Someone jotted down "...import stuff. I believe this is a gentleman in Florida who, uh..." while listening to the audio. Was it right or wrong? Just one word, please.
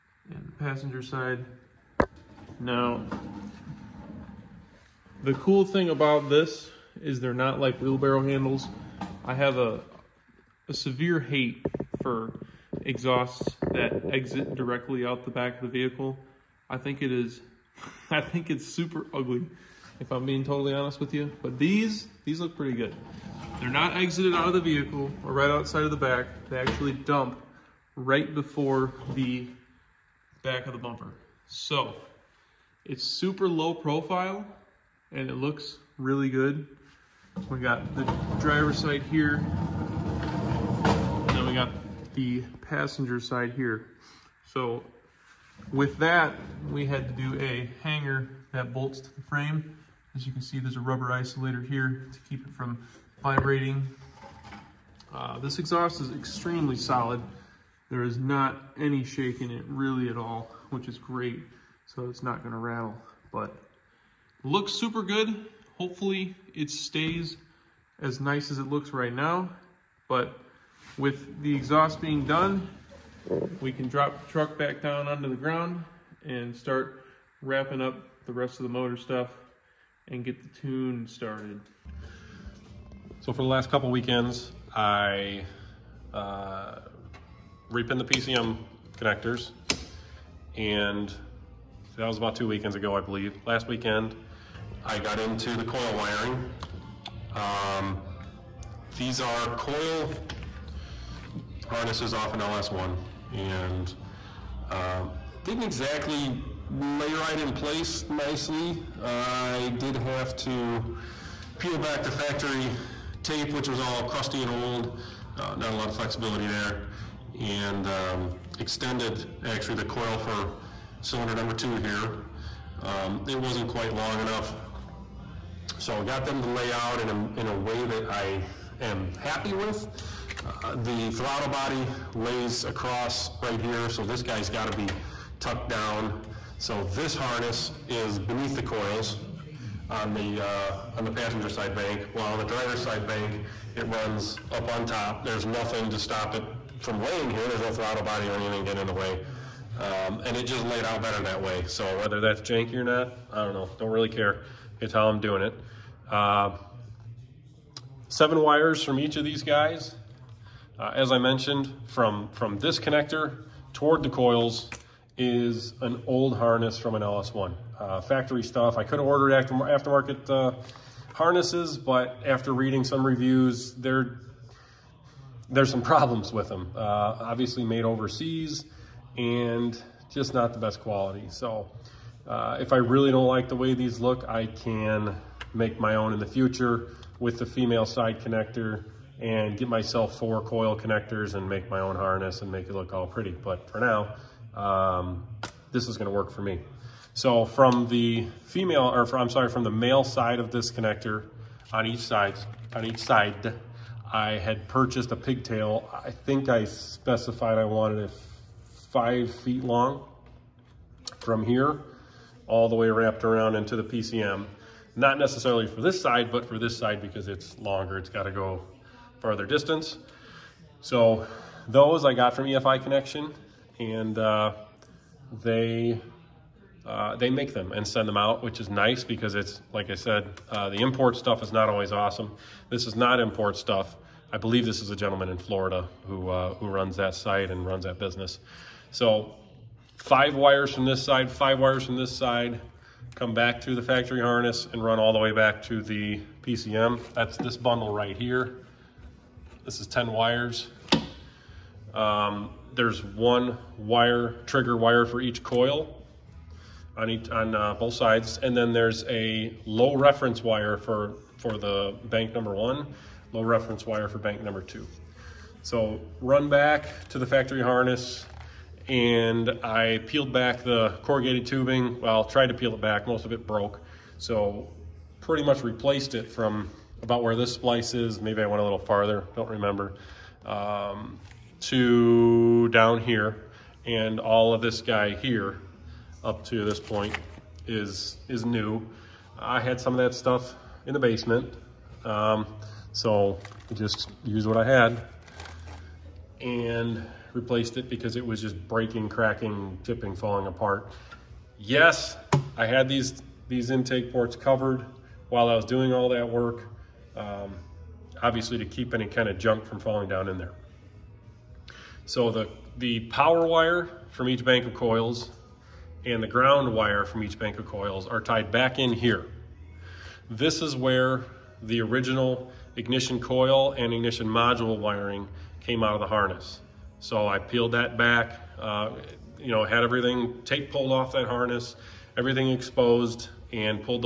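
right.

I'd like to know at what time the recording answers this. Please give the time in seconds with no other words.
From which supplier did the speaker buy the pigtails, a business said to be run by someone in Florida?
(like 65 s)
222 s.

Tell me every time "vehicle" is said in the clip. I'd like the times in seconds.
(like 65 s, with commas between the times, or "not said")
15 s, 24 s.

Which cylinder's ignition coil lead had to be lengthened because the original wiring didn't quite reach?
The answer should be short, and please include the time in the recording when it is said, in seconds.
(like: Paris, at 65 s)
2, at 121 s.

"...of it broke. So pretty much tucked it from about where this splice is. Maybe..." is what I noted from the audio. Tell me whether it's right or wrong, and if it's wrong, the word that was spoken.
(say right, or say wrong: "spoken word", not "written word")
wrong: "replaced", not "tucked".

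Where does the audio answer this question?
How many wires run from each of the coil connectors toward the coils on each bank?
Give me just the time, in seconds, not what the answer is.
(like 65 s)
158 s.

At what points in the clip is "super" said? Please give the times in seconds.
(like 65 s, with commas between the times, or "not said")
18 s, 33 s, 64 s.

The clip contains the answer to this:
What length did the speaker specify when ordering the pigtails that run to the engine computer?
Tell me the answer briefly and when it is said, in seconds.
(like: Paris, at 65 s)
5 feet, at 208 s.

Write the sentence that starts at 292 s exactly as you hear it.
Um, so I just used what I had and replaced it because it was just breaking, cracking, chipping, falling apart.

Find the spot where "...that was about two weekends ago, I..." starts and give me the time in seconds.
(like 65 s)
91 s.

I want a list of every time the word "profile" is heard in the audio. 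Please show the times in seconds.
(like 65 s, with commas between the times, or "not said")
33 s.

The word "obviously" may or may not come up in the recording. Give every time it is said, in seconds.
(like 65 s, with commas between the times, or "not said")
177 s, 308 s.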